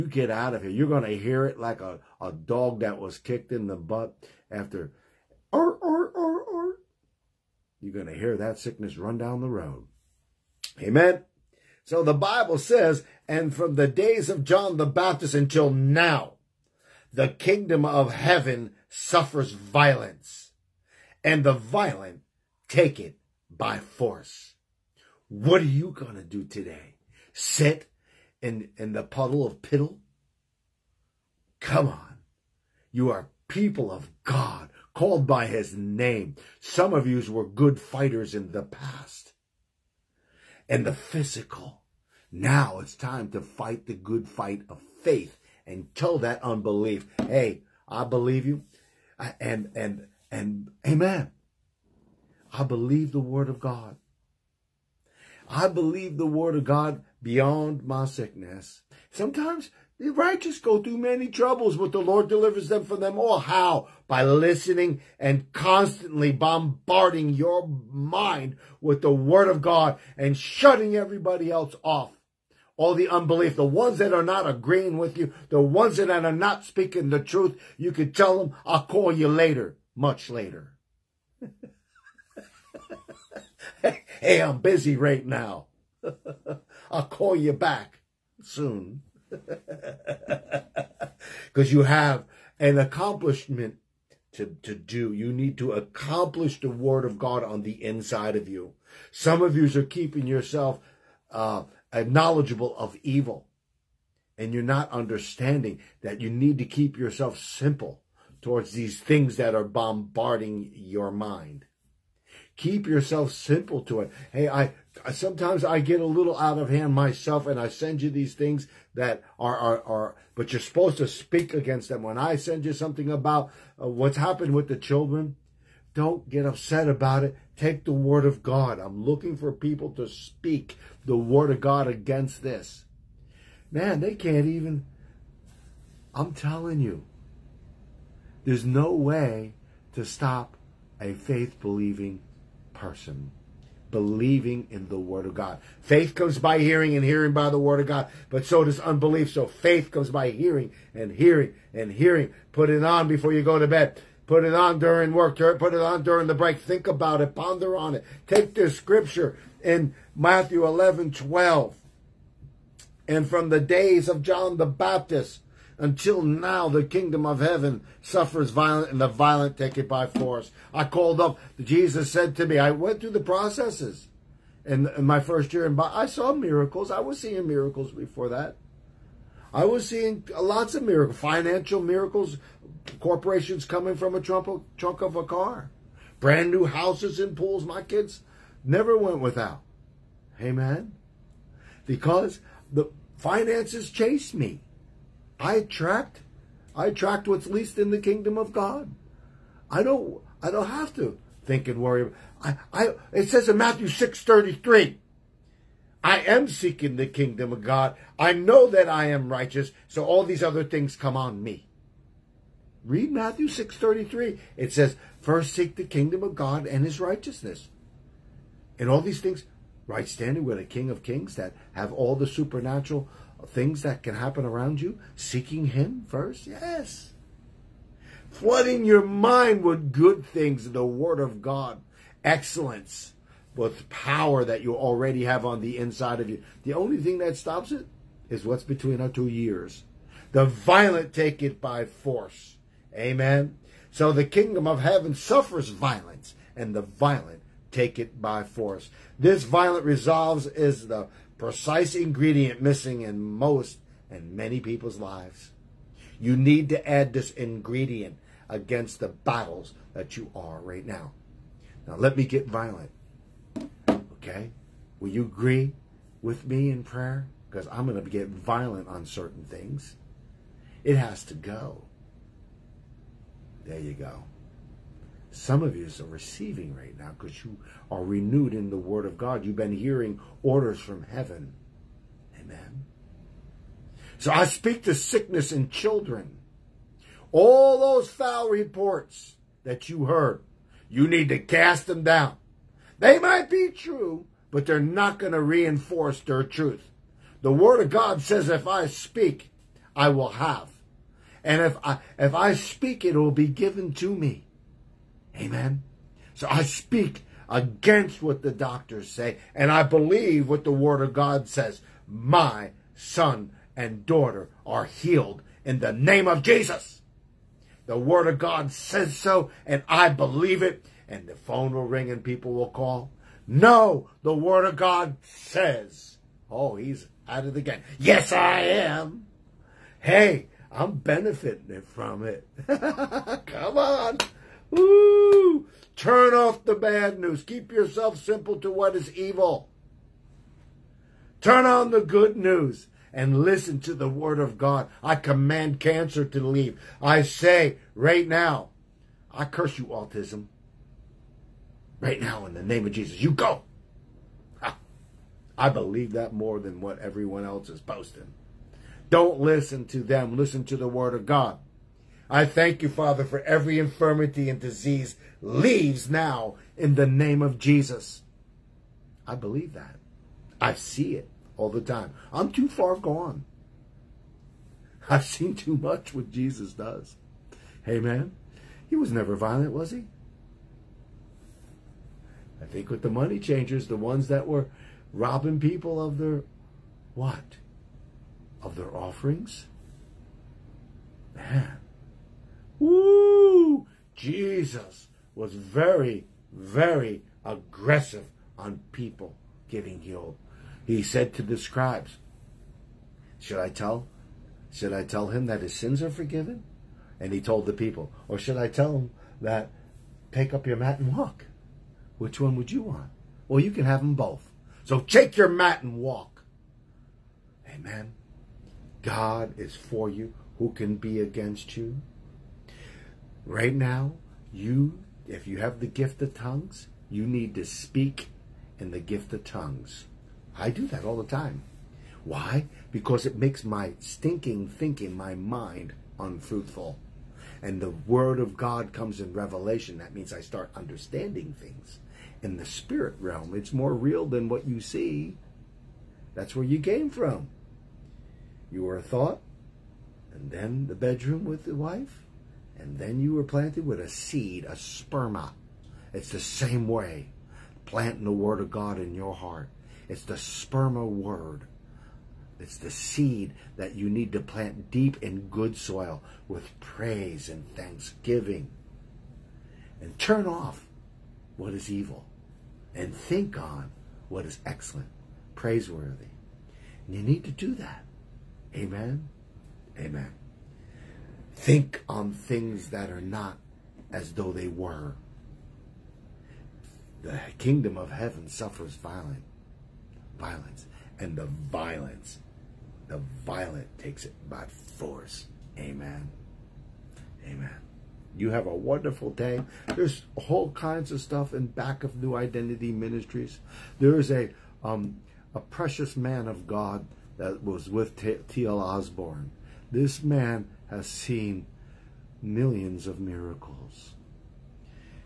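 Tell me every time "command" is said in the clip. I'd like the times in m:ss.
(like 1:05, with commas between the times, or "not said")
5:45.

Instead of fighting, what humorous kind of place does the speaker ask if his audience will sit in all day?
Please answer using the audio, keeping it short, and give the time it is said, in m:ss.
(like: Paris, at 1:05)
Puddle of piddle, at 0:29.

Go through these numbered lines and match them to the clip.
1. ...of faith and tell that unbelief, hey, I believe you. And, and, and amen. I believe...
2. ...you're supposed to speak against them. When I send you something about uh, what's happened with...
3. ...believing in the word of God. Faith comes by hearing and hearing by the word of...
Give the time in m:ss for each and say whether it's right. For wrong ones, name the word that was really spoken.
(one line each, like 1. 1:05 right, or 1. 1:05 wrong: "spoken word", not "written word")
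1. 0:44 right
2. 2:00 right
3. 2:23 right.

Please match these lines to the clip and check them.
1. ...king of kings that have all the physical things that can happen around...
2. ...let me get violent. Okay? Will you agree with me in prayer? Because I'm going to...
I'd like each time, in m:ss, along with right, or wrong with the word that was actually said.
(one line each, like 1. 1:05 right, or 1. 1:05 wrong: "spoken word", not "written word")
1. 3:40 wrong: "supernatural", not "physical"
2. 4:21 right.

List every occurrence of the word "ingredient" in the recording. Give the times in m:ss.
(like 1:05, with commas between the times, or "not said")
4:11, 4:17.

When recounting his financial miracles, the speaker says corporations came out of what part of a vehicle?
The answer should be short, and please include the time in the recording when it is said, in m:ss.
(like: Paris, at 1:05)
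Trunk of a car, at 3:04.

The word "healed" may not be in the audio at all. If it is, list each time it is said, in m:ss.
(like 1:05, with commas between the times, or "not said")
5:14, 6:40.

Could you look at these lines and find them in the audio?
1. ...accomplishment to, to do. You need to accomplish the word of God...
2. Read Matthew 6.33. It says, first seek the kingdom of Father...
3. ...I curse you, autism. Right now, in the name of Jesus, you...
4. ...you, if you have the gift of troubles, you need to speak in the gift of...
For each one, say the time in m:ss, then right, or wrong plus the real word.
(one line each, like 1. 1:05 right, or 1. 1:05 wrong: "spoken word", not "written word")
1. 1:32 right
2. 3:32 wrong: "God", not "Father"
3. 5:49 right
4. 7:04 wrong: "tongues", not "troubles".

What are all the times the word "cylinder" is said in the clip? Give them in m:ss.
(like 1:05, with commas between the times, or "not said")
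not said.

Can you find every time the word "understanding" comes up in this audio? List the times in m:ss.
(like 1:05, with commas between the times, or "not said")
1:44, 7:20.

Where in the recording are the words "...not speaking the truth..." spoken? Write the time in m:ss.
1:16.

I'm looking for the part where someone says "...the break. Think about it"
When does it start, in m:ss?
2:36.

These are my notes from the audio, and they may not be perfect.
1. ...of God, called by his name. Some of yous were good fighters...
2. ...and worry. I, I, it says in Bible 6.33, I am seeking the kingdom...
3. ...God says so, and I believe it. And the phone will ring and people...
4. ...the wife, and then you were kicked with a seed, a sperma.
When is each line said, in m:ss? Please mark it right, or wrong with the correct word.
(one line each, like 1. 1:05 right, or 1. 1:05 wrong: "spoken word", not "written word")
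1. 0:33 right
2. 3:21 wrong: "Matthew", not "Bible"
3. 5:18 right
4. 7:31 wrong: "planted", not "kicked".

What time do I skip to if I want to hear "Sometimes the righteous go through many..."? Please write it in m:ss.
0:59.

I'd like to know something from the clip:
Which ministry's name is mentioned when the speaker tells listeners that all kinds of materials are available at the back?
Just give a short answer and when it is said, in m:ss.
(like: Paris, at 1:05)
New Identity Ministries, at 8:22.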